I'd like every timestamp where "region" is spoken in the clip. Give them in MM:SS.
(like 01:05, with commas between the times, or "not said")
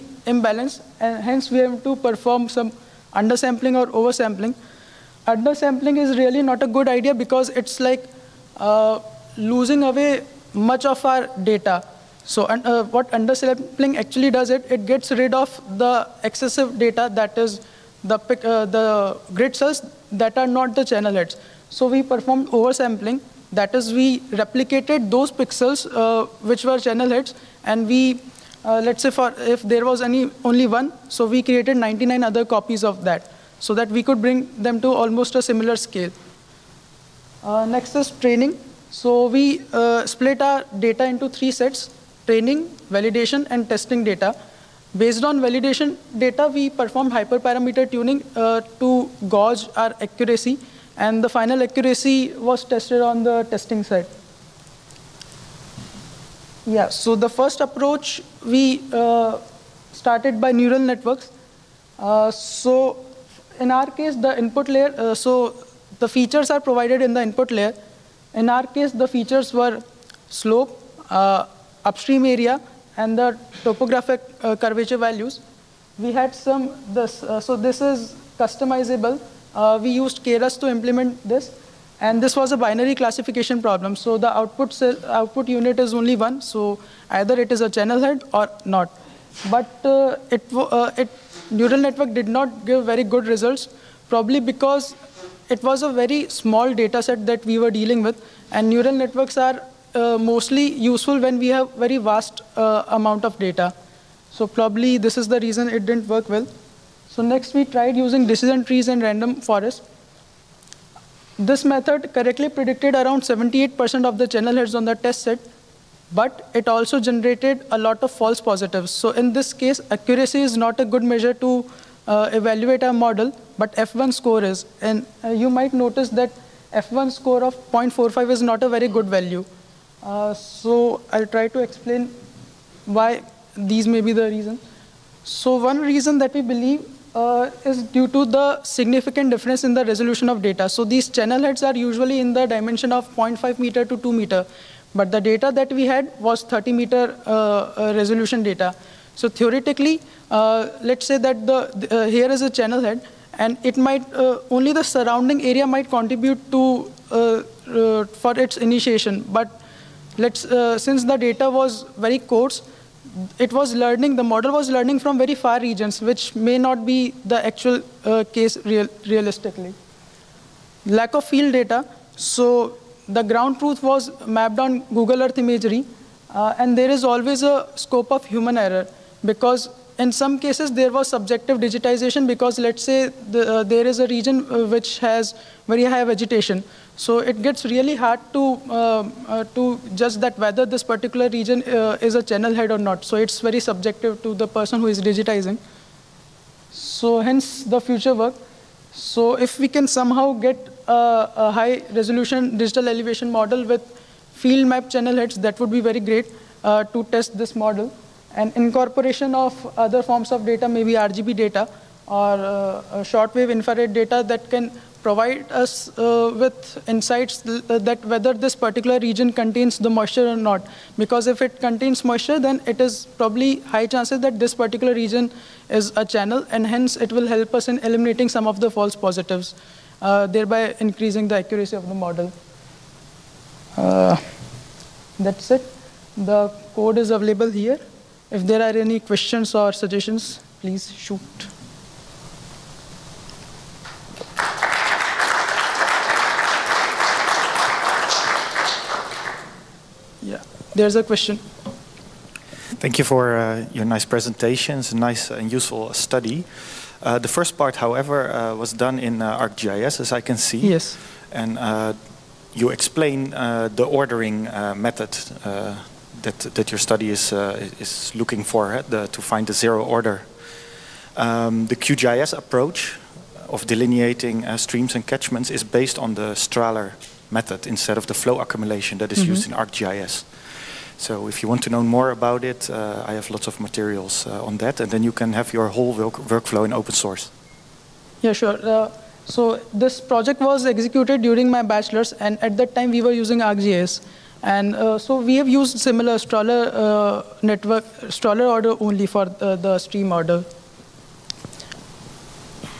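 02:45, 03:04, 03:11, 03:38, 03:44.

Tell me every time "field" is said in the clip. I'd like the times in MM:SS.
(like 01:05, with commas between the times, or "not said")
02:51, 03:24.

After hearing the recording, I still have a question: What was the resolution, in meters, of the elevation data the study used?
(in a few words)
30 meters.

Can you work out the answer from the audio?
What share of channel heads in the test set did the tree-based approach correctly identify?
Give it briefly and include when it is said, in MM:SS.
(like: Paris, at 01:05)
78%, at 01:53.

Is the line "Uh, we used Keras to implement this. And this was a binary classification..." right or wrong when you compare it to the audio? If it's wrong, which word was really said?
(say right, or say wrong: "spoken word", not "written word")
right.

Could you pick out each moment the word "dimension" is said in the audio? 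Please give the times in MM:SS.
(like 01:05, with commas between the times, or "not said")
02:22.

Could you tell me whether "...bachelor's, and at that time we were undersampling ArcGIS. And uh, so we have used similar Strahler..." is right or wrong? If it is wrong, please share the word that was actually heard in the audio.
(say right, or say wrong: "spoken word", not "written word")
wrong: "using", not "undersampling".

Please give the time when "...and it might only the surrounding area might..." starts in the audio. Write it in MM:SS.
02:33.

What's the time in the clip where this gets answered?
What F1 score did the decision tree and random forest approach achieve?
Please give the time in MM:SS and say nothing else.
02:07.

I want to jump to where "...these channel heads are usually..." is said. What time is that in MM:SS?
02:20.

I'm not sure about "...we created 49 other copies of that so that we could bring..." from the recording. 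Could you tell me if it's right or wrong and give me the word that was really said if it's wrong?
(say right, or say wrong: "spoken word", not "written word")
wrong: "99", not "49".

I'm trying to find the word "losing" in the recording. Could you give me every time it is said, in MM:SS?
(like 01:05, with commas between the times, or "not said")
00:09.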